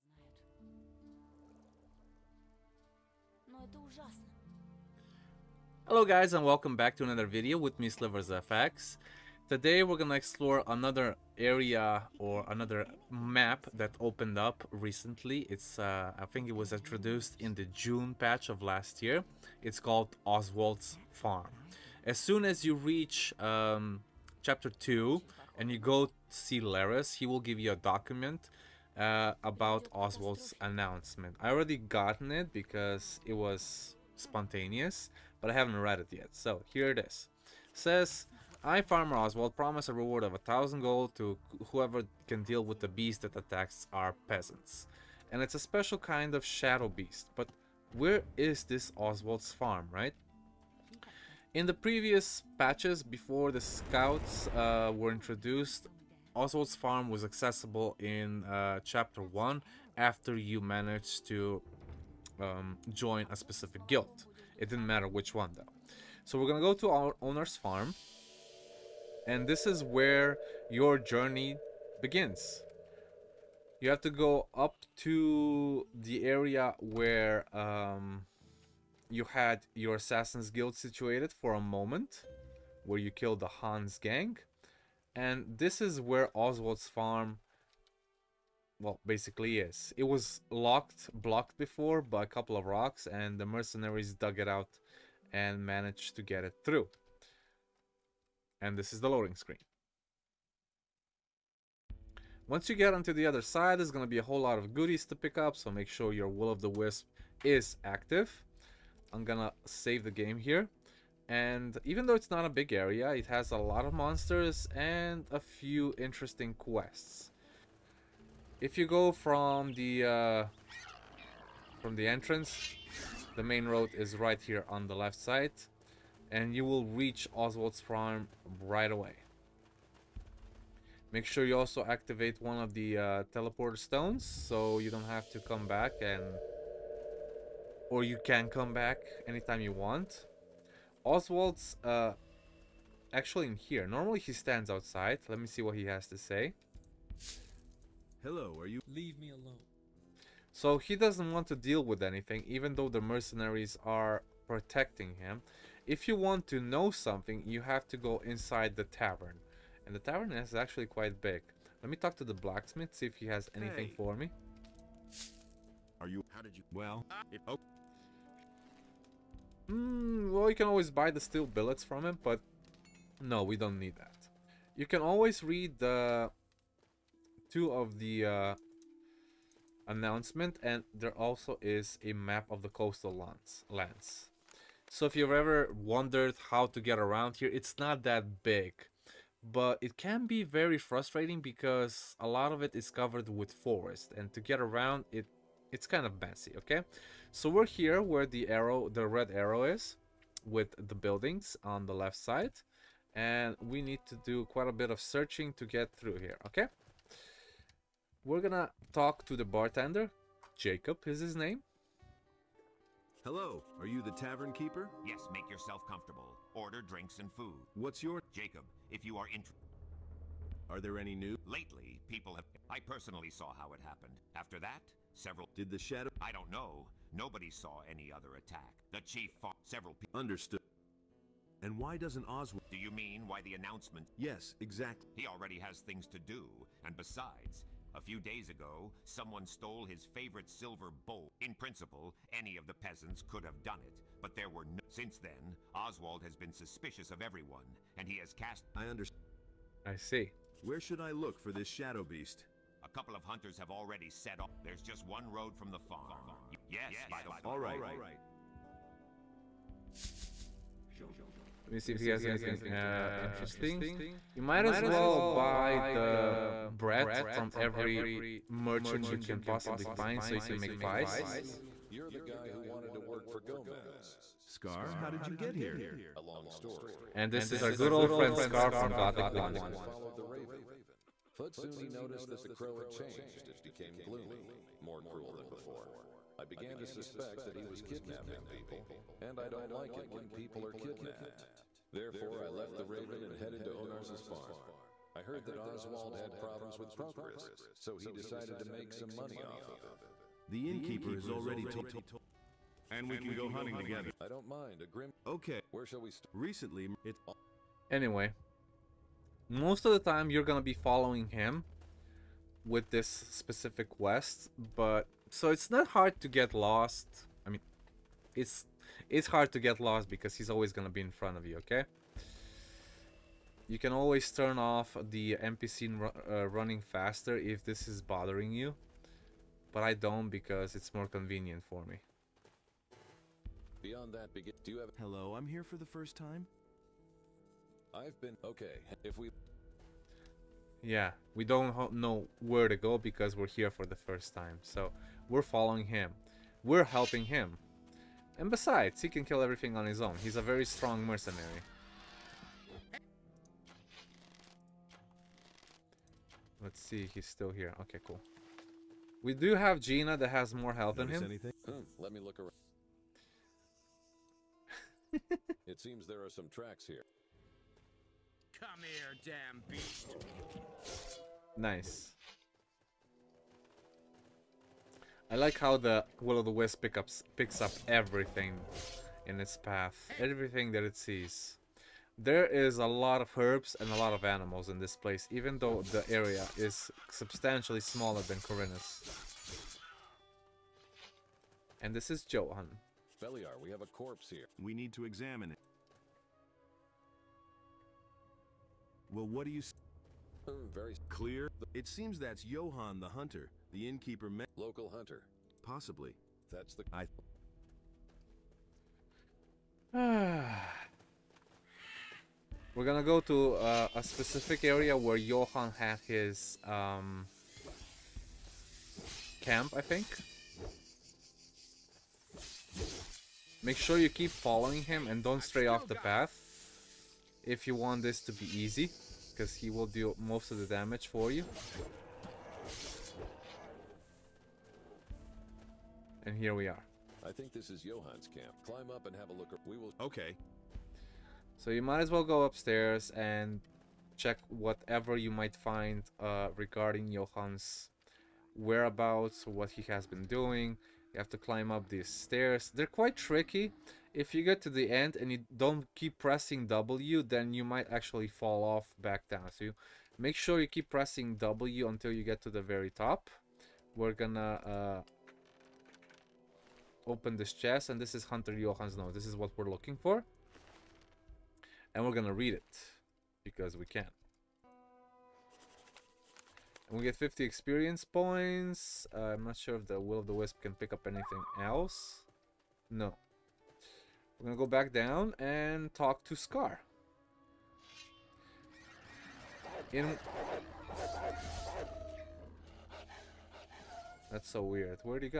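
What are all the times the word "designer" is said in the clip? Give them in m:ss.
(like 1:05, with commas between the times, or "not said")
not said.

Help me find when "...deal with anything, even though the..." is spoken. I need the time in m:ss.
2:31.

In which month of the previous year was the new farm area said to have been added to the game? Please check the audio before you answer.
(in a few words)
June.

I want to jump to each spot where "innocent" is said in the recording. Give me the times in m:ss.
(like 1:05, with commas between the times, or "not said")
not said.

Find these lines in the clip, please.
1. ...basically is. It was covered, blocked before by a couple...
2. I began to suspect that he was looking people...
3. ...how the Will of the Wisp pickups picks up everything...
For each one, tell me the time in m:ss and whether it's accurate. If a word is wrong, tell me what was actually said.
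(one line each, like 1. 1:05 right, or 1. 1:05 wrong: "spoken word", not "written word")
1. 1:29 wrong: "locked", not "covered"
2. 4:46 wrong: "kidnapping", not "looking"
3. 6:15 right.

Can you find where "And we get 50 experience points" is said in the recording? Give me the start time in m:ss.
7:56.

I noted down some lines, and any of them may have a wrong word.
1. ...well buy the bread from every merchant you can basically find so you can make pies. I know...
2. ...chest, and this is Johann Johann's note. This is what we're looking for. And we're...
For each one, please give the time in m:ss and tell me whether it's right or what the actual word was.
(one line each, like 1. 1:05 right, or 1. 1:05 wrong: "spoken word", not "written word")
1. 4:24 wrong: "possibly", not "basically"
2. 7:47 wrong: "Hunter", not "Johann".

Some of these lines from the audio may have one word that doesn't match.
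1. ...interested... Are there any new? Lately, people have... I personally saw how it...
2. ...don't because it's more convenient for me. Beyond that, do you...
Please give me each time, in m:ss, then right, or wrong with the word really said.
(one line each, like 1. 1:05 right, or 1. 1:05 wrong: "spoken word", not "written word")
1. 3:39 right
2. 5:29 right.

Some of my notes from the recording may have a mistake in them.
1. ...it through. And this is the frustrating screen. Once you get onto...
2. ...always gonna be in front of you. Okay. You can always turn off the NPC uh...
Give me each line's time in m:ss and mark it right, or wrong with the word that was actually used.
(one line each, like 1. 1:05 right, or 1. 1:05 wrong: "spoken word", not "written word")
1. 1:36 wrong: "loading", not "frustrating"
2. 5:20 right.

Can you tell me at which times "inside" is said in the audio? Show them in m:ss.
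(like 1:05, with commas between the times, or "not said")
2:38.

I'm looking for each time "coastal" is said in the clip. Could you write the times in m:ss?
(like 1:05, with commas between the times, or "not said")
3:02.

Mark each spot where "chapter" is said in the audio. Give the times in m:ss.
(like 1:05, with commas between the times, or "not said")
0:24, 0:58.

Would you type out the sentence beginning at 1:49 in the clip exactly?
I'm going to save the game here.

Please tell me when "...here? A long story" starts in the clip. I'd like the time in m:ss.
4:35.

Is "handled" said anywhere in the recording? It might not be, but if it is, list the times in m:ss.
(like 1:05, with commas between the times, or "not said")
not said.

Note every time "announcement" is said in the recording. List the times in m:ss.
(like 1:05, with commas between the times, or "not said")
0:30, 2:59, 3:53.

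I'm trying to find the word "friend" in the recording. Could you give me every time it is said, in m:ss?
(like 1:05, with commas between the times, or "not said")
4:38.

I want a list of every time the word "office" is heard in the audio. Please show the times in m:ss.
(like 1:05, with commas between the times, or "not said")
not said.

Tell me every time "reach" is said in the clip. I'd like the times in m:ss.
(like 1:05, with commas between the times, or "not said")
0:22, 2:06.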